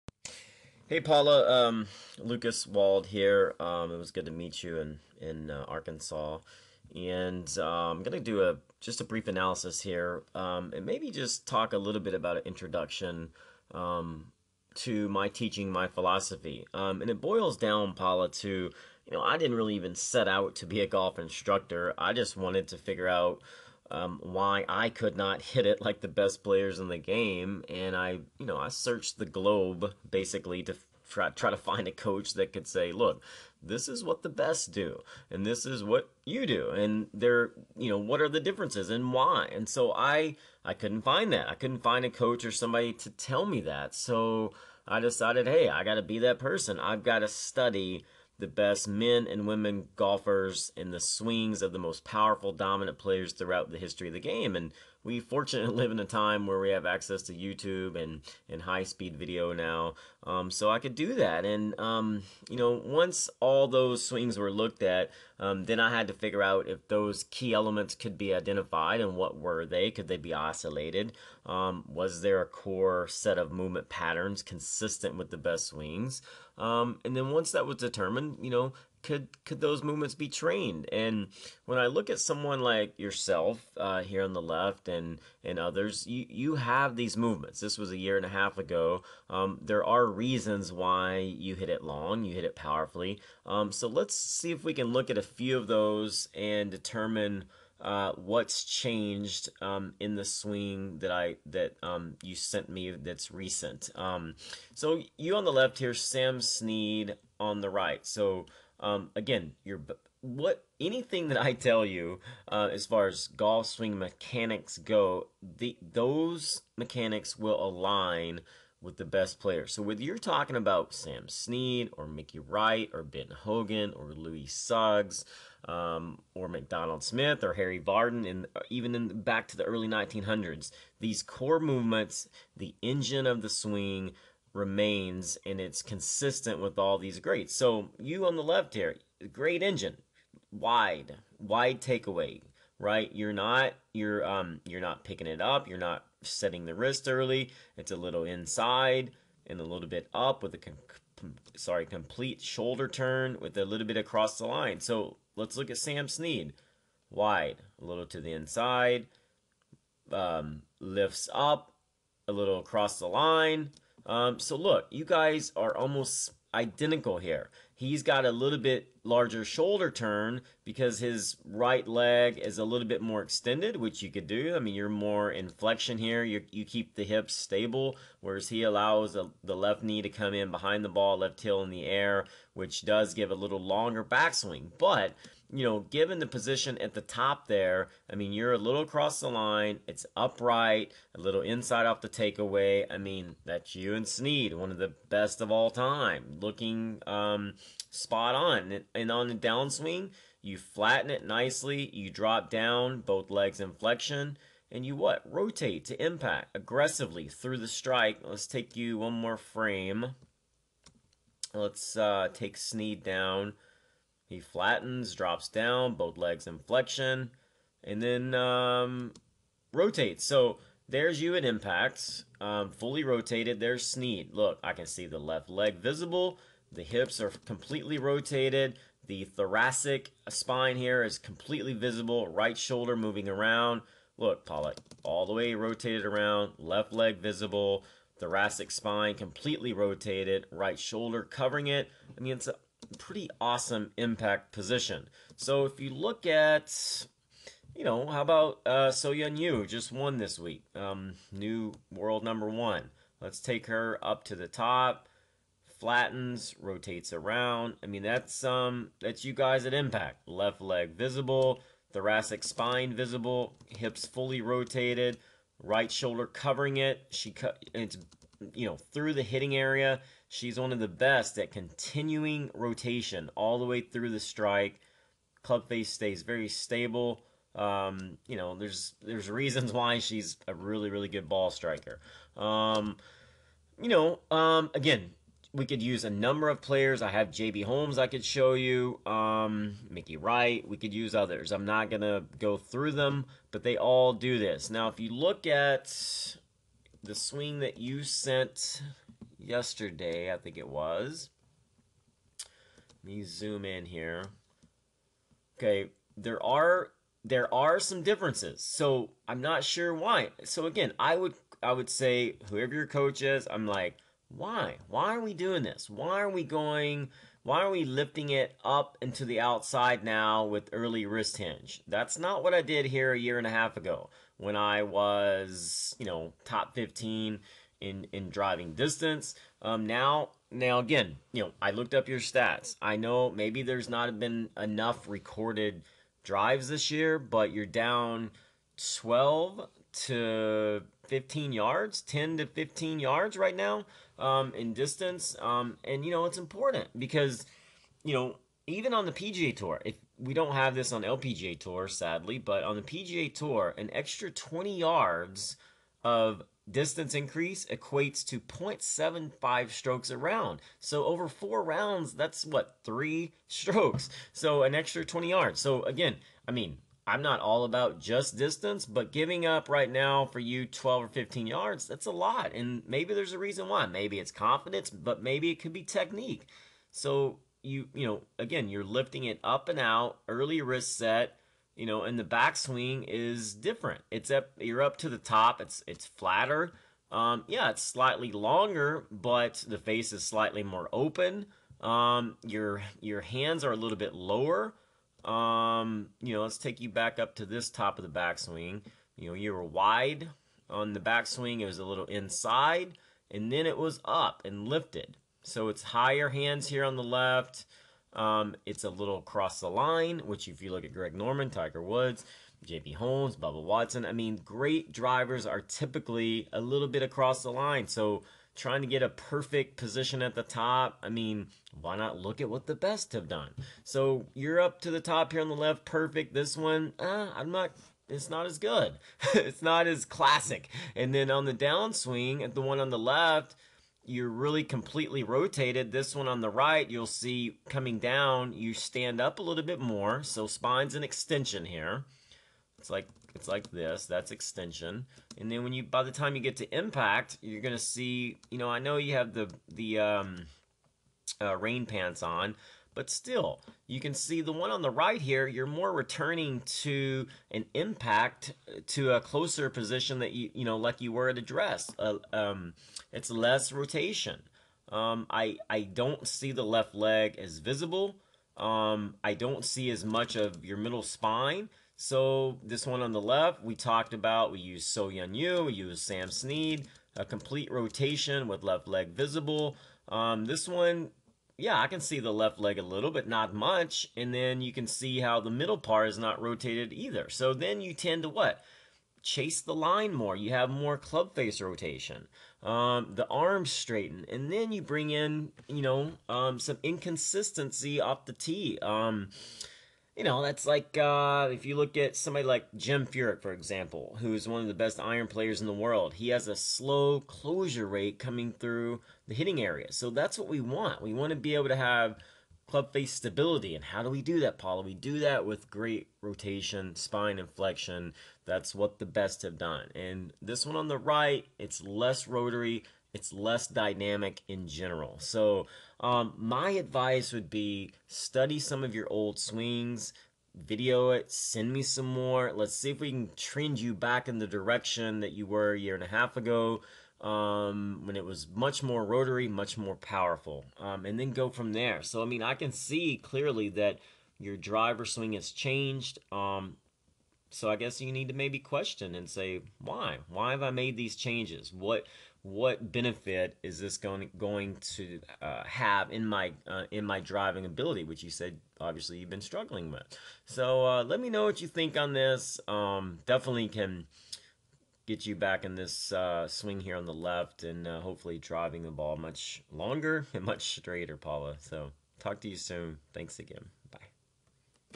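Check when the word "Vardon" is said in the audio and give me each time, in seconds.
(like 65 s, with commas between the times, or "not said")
127 s.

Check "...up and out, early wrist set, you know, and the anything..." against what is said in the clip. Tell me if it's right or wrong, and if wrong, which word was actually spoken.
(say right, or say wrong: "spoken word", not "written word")
wrong: "backswing", not "anything".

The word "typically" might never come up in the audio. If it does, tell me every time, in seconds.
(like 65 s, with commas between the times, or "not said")
415 s.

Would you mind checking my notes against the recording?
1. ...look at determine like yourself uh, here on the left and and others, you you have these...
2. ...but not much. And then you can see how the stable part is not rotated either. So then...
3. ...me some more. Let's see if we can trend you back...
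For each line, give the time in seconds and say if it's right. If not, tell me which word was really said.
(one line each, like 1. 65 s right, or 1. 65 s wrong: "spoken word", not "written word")
1. 81 s wrong: "someone", not "determine"
2. 483 s wrong: "middle", not "stable"
3. 531 s right.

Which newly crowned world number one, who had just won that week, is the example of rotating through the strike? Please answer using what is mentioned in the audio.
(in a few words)
So Yeon Ryu.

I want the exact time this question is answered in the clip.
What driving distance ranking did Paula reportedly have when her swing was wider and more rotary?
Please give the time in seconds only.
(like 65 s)
326 s.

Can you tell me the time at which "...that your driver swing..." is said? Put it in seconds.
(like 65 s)
543 s.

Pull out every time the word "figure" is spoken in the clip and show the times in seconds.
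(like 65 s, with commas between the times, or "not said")
22 s, 66 s.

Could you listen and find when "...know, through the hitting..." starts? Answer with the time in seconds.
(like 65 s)
268 s.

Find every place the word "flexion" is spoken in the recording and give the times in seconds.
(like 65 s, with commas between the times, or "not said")
175 s, 203 s, 216 s.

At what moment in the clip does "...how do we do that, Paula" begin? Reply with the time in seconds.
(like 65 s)
513 s.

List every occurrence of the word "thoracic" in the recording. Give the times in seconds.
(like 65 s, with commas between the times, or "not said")
229 s, 238 s, 261 s.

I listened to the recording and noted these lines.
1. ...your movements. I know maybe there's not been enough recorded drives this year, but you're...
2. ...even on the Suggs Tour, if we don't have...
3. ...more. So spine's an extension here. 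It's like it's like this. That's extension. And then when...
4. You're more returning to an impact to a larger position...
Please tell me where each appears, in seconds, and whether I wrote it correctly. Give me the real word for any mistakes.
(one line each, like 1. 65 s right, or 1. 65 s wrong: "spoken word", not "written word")
1. 332 s wrong: "stats", not "movements"
2. 348 s wrong: "PGA", not "Suggs"
3. 439 s right
4. 455 s wrong: "closer", not "larger".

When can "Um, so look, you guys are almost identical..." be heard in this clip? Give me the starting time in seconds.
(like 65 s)
164 s.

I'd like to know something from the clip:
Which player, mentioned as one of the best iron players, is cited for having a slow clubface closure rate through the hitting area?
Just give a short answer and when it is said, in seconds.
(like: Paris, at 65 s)
Jim Furyk, at 502 s.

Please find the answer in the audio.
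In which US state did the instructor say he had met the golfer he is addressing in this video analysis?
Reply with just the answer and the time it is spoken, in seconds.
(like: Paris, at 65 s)
Arkansas, at 5 s.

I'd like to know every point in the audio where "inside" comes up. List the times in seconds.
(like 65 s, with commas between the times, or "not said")
148 s, 158 s, 191 s, 402 s.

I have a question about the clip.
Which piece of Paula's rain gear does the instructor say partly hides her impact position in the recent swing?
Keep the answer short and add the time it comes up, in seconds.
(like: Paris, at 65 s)
rain pants, at 451 s.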